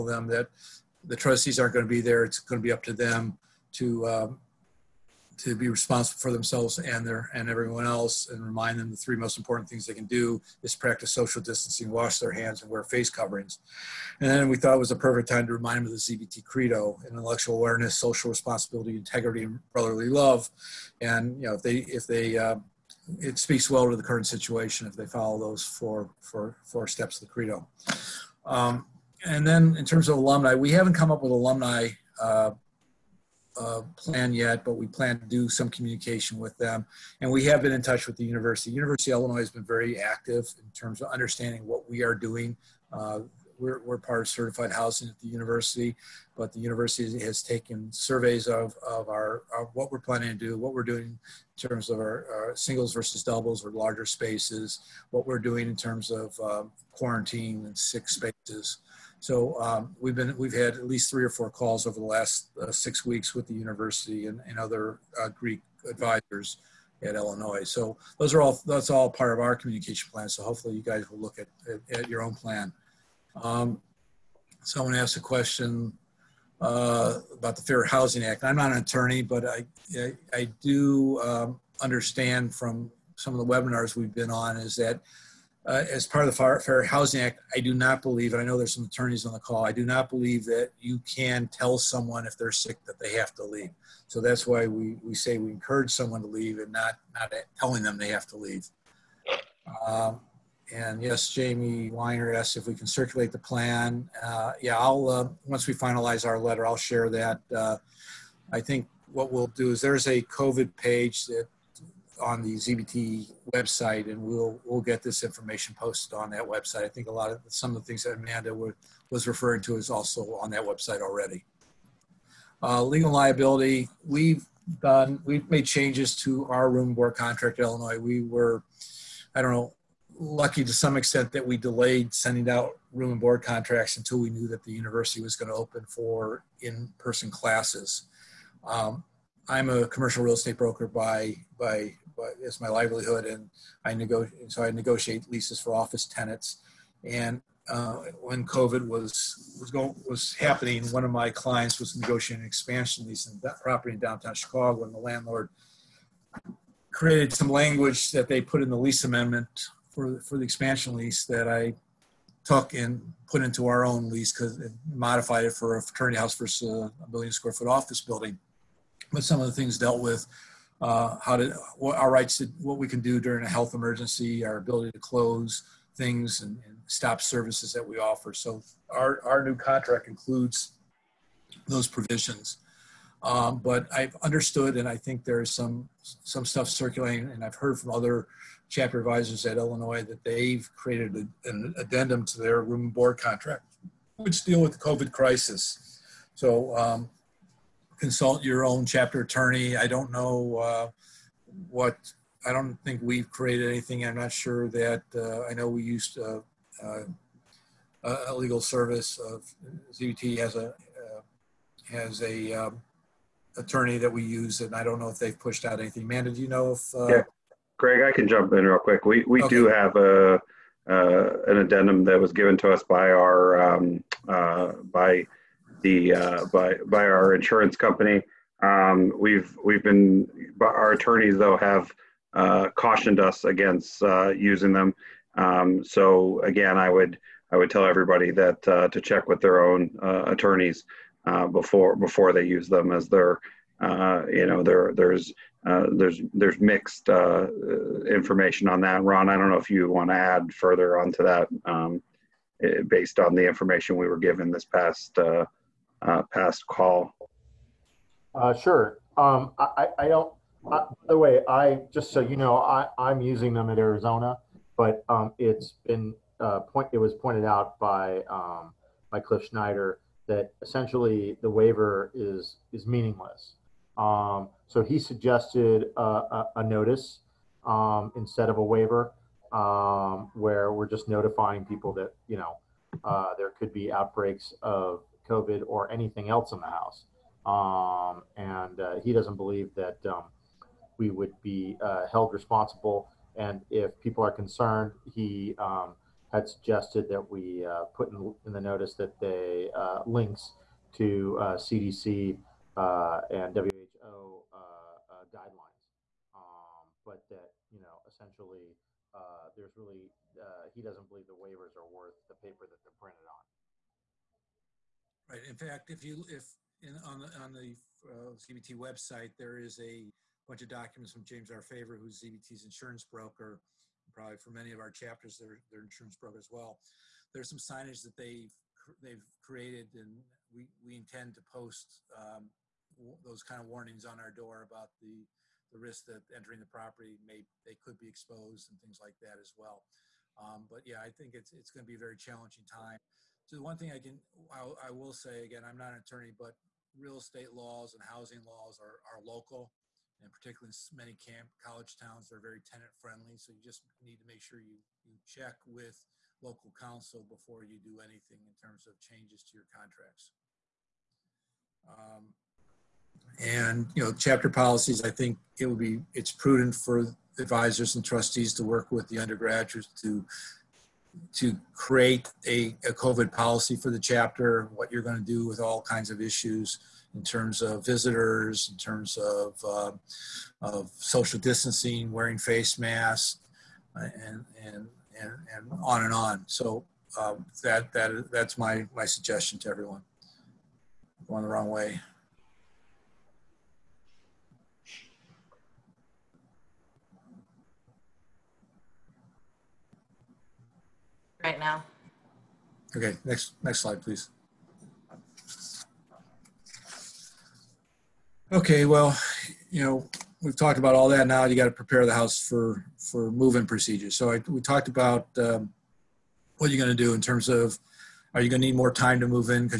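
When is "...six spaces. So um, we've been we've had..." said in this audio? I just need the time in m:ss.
0:57.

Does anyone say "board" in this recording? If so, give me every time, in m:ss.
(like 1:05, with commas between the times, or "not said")
2:06, 2:13, 3:12.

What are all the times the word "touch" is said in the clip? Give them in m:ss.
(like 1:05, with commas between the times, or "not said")
0:37.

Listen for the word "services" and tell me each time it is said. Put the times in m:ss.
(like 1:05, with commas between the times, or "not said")
2:57, 3:28.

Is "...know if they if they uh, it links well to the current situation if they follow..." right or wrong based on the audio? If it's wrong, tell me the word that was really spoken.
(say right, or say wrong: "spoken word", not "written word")
wrong: "speaks", not "links".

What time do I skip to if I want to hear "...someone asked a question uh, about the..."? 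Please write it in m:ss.
1:14.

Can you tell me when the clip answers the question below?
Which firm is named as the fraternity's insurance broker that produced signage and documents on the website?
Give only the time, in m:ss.
5:21.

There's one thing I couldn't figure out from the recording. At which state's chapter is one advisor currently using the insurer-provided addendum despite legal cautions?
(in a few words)
Arizona.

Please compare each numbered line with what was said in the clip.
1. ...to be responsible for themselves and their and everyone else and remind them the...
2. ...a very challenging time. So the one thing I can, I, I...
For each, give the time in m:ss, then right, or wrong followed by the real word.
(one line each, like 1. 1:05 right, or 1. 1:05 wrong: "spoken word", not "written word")
1. 0:05 right
2. 5:41 right.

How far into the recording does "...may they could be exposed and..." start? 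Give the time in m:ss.
5:37.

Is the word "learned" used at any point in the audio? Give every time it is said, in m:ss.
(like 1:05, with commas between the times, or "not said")
not said.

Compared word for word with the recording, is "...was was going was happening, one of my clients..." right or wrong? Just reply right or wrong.
right.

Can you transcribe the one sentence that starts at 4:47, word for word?
Um, and uh, he doesn't believe that um, we would be uh, held responsible.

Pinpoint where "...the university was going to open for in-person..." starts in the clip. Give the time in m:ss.
2:14.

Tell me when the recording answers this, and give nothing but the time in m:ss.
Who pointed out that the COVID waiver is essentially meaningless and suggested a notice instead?
4:29.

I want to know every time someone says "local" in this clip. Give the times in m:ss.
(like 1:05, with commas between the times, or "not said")
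5:49, 5:56.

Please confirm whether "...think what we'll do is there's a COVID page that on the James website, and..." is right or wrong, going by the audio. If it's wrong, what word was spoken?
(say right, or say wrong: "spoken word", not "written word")
wrong: "ZBT", not "James".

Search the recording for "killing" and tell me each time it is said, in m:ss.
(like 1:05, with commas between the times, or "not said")
not said.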